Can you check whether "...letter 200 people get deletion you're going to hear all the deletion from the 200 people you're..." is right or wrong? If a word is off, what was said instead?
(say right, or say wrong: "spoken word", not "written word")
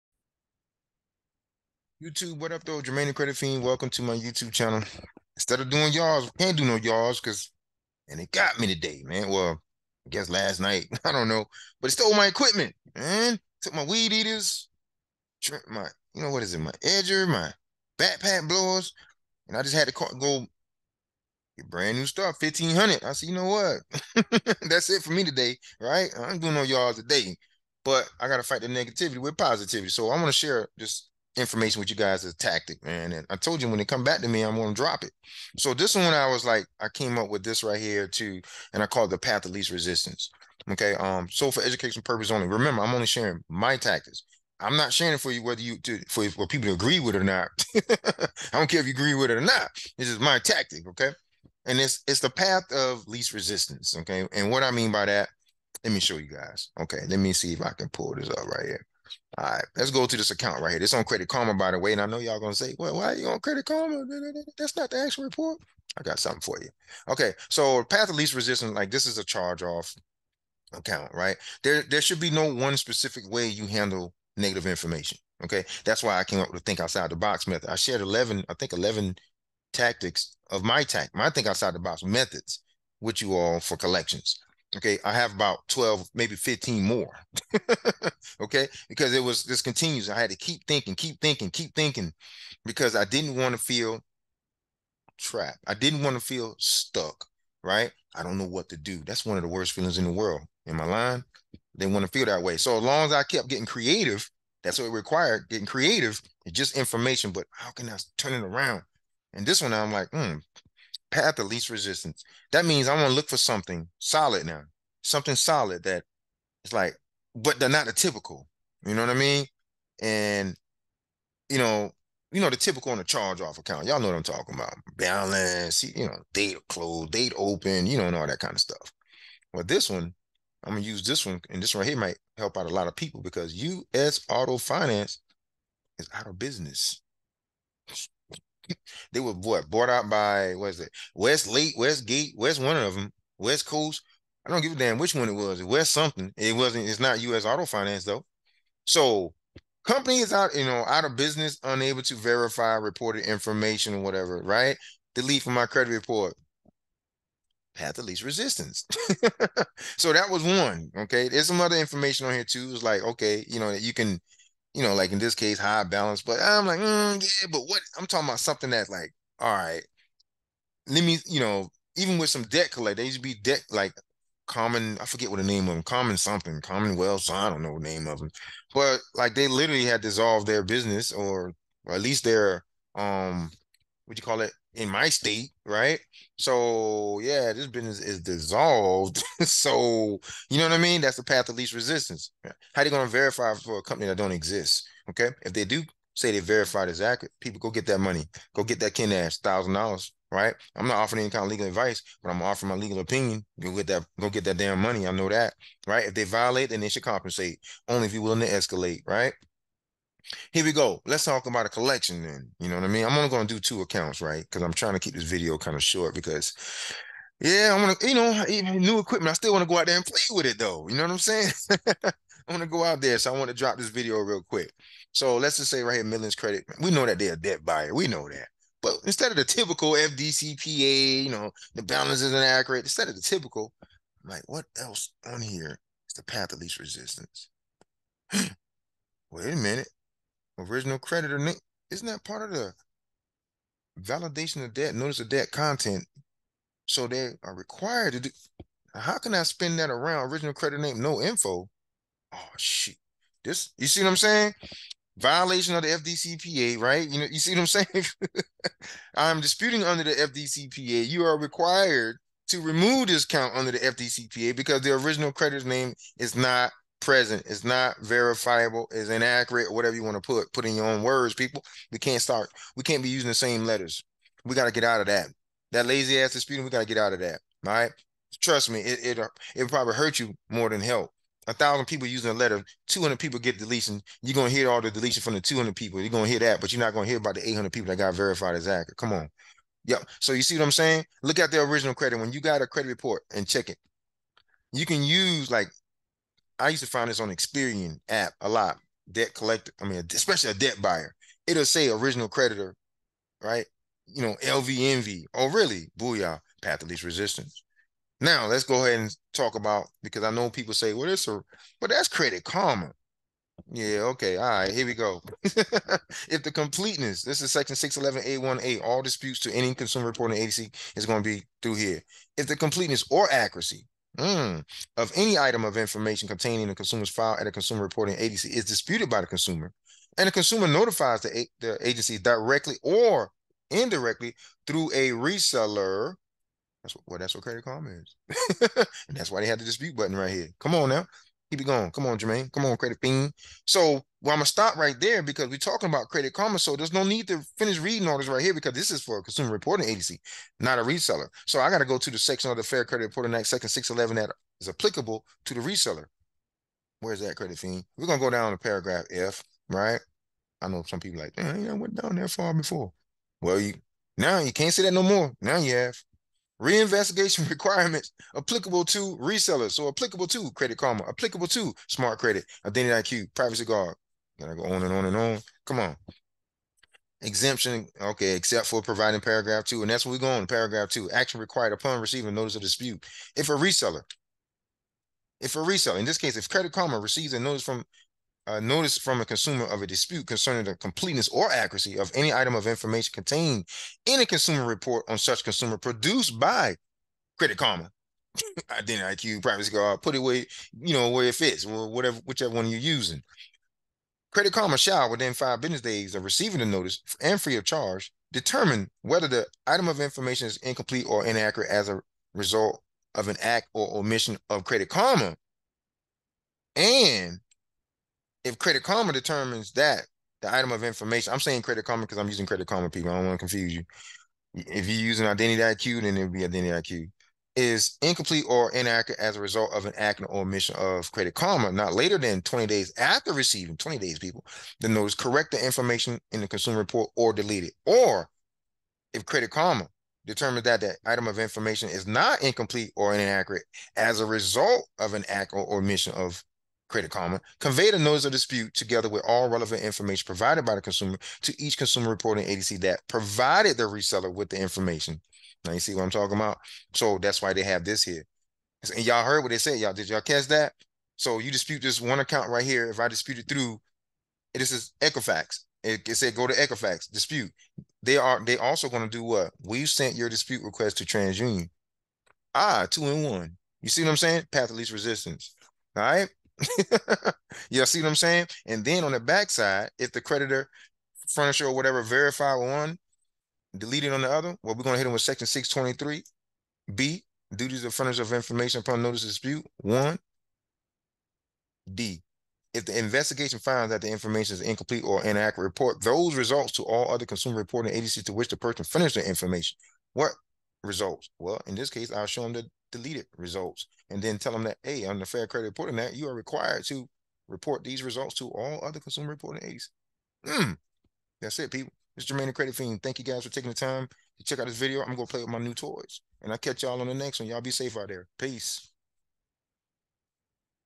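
right.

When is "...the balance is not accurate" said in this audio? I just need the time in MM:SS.
03:51.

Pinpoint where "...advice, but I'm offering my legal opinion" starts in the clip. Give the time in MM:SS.
03:21.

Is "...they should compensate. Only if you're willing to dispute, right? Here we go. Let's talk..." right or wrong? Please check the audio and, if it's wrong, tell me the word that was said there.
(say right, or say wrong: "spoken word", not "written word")
wrong: "escalate", not "dispute".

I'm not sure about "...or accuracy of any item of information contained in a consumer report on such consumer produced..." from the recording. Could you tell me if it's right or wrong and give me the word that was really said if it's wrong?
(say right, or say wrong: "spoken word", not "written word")
right.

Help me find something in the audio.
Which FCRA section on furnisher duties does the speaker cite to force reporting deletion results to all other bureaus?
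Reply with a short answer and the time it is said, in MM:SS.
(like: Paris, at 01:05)
623B, at 08:05.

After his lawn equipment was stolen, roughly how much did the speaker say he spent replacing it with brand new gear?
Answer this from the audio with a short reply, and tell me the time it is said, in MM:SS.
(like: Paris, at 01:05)
1500, at 00:22.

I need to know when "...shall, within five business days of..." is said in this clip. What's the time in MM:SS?
06:44.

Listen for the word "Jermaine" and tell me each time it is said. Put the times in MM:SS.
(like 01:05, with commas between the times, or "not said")
00:02, 05:42, 08:32.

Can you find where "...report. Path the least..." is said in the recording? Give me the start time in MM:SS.
02:35.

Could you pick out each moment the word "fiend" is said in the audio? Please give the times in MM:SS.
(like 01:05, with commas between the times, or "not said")
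00:03, 05:43, 05:57, 08:32.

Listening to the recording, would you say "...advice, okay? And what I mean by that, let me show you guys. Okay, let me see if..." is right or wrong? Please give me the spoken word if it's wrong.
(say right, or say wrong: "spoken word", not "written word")
wrong: "resistance", not "advice".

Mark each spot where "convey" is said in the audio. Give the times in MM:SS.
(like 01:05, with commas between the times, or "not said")
07:27.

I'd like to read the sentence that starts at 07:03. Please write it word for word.
I don't want to confuse you.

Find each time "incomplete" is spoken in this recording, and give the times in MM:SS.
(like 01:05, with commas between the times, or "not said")
06:50, 07:08, 07:22, 08:14.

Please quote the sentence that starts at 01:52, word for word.
That means I am going to look for something solid now, something solid that it's like, but they're not the typical.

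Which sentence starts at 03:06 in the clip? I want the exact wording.
So yeah, this business is dissolved.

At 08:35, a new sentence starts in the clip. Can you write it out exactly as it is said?
I'm going to play with my new toys.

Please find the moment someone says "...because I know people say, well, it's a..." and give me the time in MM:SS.
05:10.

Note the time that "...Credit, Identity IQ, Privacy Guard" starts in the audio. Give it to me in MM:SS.
06:12.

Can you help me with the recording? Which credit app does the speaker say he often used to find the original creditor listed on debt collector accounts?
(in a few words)
Experian.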